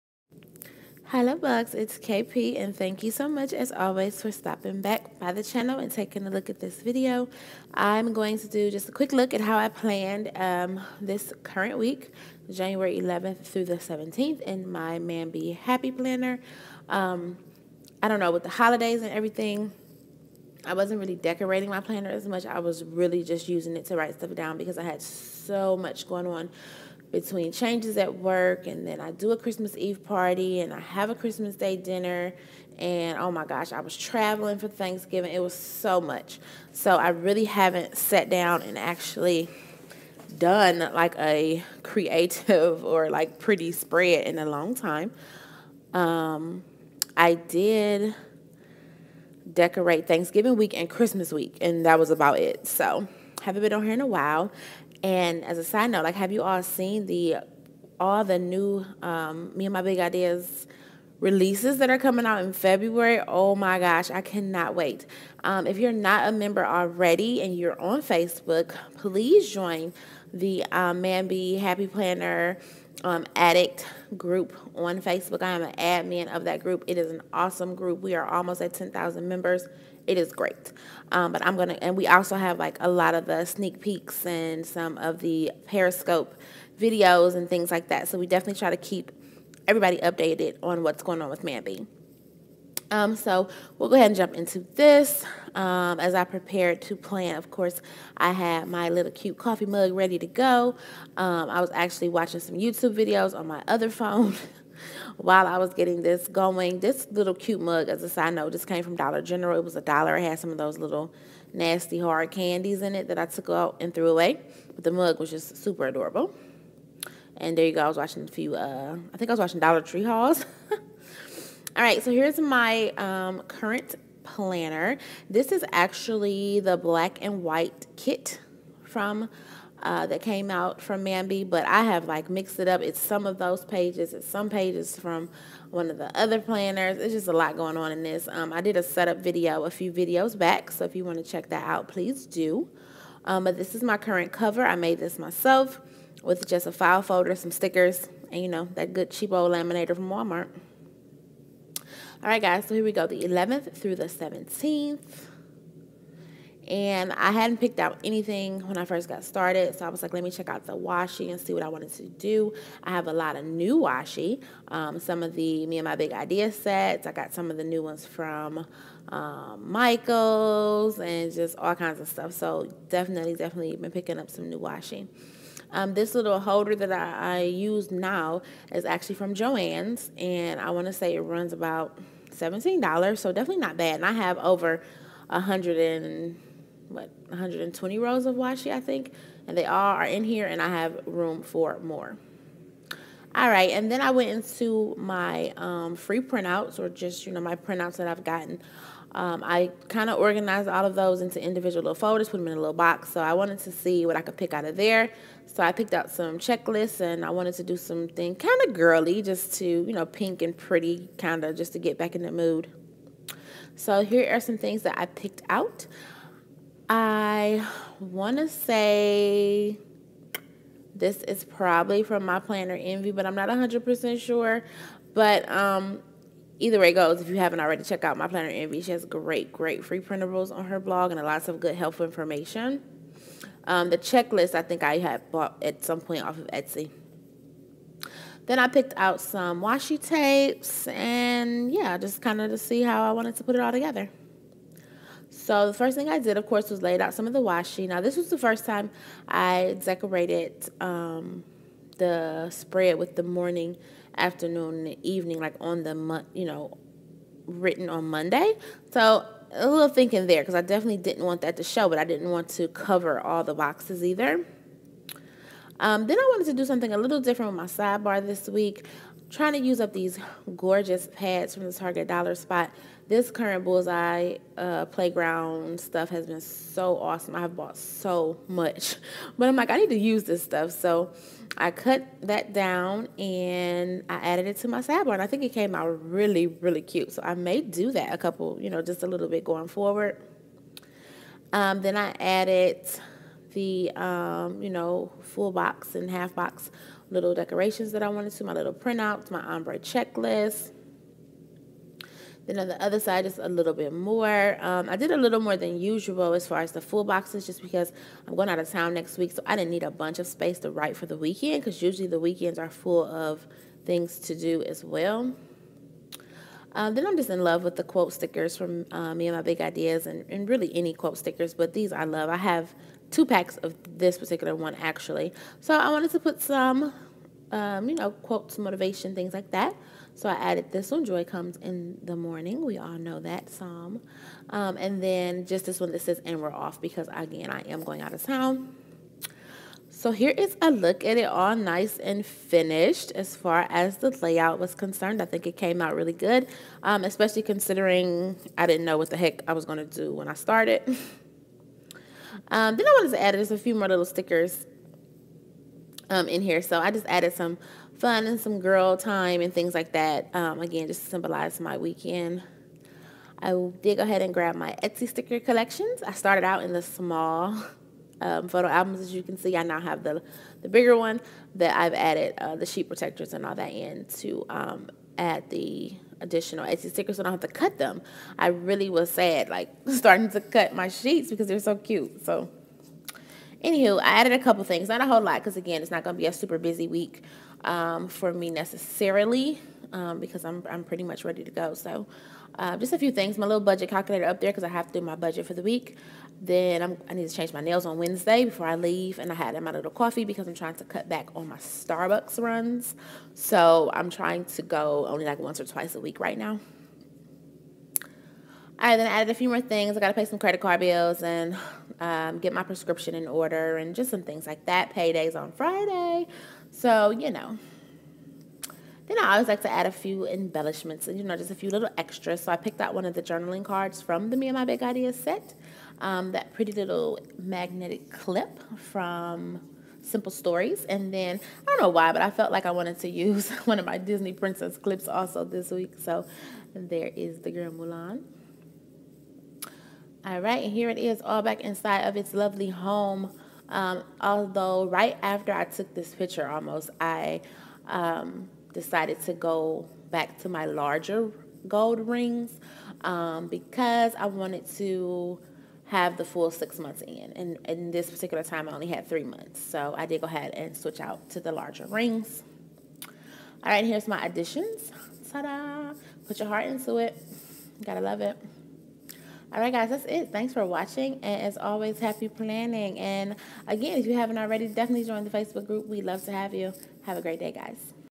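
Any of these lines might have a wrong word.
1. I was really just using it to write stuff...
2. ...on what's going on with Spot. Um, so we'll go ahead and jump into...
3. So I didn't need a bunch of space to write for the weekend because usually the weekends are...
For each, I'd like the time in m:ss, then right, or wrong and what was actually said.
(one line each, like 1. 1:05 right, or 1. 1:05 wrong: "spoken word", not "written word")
1. 0:22 right
2. 1:30 wrong: "Mambi", not "Spot"
3. 5:09 right.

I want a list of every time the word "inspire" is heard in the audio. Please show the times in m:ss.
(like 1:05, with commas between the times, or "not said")
not said.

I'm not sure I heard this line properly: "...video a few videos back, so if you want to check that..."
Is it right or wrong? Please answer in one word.
right.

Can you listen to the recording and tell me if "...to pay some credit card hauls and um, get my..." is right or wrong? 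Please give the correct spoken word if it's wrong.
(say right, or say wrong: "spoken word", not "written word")
wrong: "bills", not "hauls".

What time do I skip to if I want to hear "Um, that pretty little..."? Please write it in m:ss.
7:05.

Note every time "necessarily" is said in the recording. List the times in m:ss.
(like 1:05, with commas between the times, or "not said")
6:28.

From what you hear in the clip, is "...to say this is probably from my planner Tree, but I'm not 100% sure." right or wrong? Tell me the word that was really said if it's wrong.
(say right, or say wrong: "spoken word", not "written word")
wrong: "Envy", not "Tree".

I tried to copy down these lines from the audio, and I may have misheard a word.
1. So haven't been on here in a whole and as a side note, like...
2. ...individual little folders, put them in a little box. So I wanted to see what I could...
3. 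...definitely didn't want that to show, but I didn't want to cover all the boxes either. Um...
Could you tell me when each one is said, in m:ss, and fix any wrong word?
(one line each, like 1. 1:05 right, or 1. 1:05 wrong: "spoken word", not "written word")
1. 0:52 wrong: "while", not "whole"
2. 3:21 right
3. 4:20 right.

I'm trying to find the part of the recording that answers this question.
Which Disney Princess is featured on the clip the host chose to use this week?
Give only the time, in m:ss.
7:17.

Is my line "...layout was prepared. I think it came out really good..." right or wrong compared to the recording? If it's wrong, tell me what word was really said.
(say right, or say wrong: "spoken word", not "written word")
wrong: "concerned", not "prepared".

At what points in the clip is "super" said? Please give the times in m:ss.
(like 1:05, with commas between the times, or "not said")
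1:55, 6:26.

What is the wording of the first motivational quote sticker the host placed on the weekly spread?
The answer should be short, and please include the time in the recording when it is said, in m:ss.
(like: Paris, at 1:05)
Joy Comes in the Morning, at 5:31.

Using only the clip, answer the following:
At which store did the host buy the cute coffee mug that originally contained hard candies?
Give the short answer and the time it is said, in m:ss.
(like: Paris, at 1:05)
Dollar General, at 1:48.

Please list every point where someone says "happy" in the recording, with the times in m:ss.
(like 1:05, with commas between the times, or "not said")
0:15, 1:11, 7:51.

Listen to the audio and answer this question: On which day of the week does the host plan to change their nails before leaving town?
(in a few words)
Wednesday.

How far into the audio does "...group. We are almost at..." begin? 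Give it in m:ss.
1:17.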